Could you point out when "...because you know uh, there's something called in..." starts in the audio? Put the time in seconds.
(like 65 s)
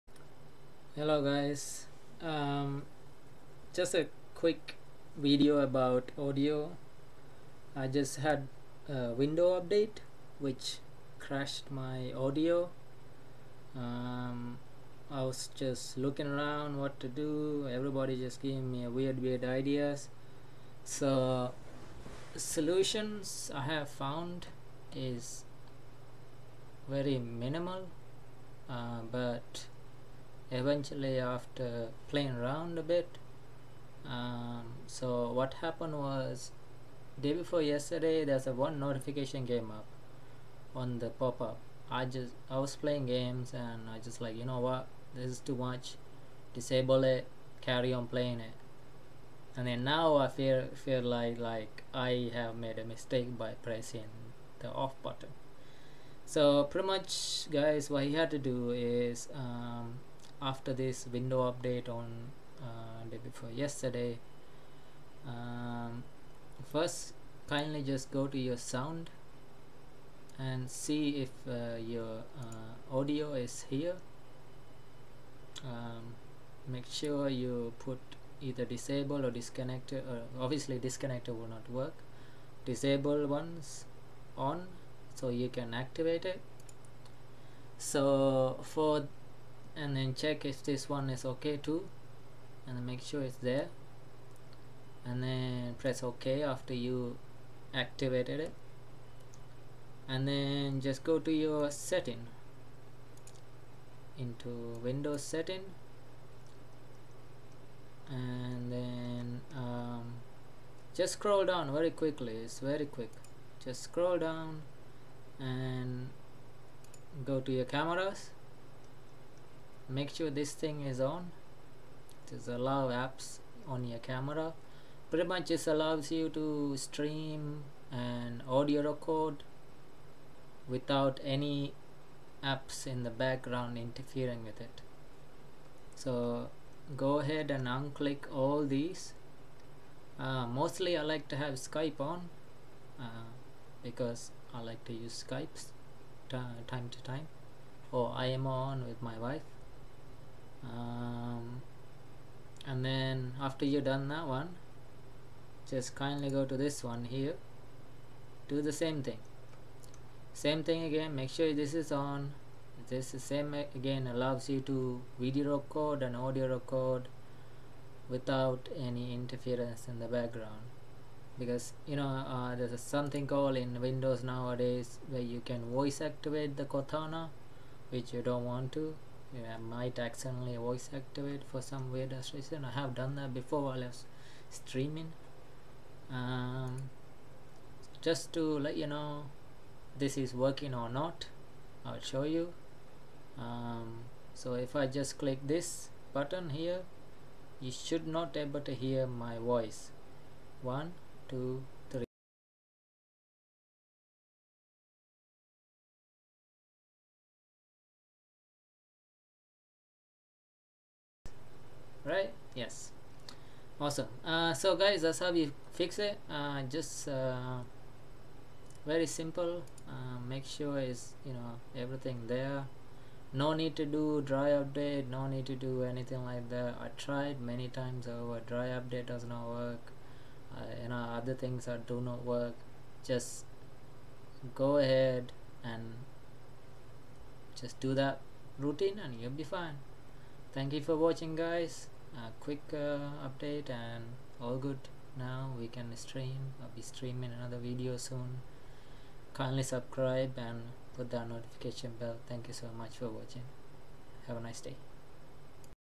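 171 s.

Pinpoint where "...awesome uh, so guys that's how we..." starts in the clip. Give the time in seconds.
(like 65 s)
213 s.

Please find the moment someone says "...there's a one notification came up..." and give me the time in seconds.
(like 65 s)
38 s.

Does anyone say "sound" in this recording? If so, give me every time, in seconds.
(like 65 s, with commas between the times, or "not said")
68 s.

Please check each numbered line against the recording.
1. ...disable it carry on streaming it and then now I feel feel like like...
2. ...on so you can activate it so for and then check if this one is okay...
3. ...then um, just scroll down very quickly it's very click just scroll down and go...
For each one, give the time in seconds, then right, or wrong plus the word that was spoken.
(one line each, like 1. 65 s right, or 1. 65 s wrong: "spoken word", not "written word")
1. 46 s wrong: "playing", not "streaming"
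2. 84 s right
3. 108 s wrong: "quick", not "click".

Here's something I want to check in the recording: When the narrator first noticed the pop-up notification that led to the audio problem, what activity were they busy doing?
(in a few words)
playing games.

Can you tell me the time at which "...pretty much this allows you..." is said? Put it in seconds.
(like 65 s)
125 s.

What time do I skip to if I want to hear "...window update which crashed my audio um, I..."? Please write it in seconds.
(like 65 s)
9 s.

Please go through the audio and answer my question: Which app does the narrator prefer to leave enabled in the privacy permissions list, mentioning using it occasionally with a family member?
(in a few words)
Skype.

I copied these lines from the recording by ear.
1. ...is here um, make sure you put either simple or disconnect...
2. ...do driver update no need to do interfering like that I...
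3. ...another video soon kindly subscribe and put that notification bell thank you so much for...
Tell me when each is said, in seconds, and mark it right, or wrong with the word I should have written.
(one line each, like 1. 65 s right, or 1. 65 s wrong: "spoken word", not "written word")
1. 73 s wrong: "disable", not "simple"
2. 223 s wrong: "anything", not "interfering"
3. 247 s right.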